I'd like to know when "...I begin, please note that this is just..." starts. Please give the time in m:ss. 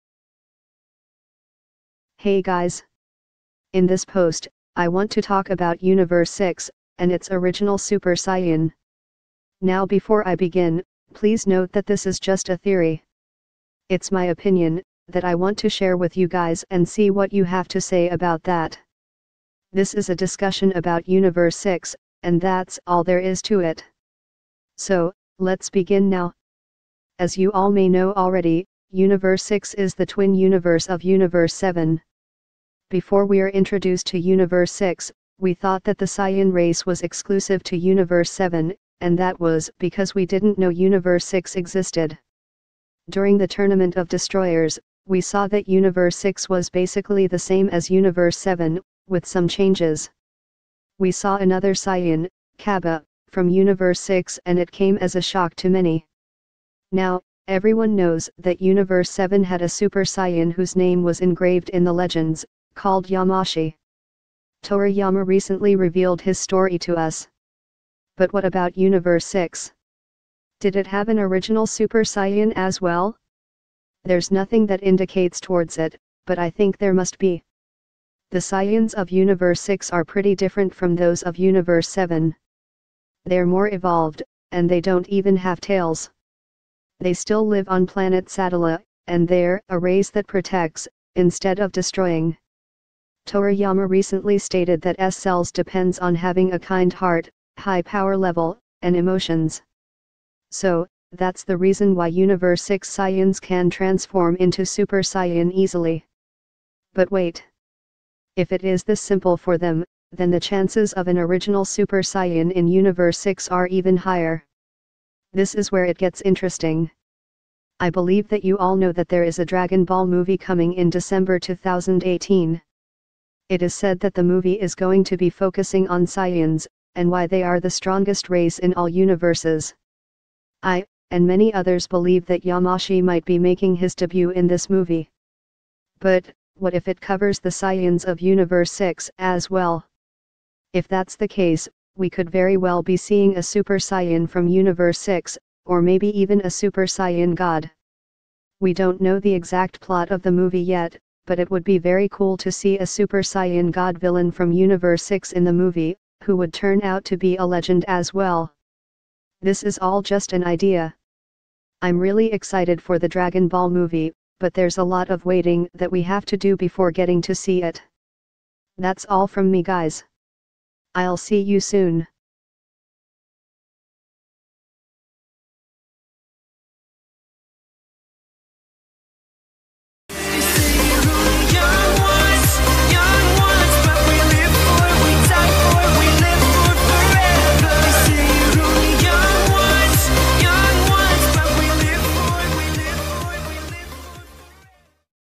0:10.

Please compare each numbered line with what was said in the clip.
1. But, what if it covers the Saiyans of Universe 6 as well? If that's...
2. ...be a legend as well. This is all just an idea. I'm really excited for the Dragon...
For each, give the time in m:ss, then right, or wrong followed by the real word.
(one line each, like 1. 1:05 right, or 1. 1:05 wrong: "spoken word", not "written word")
1. 2:15 right
2. 2:37 right.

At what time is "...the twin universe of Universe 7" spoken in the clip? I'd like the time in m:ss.
0:29.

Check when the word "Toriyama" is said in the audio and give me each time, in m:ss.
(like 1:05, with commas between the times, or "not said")
1:04, 1:33.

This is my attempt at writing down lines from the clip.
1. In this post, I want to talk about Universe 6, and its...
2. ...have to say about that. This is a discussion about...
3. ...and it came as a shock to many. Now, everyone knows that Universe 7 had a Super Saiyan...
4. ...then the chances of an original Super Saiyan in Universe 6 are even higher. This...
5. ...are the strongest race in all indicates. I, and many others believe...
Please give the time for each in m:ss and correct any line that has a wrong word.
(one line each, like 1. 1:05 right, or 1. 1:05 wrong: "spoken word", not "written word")
1. 0:03 right
2. 0:17 right
3. 0:54 right
4. 1:50 right
5. 2:07 wrong: "universes", not "indicates".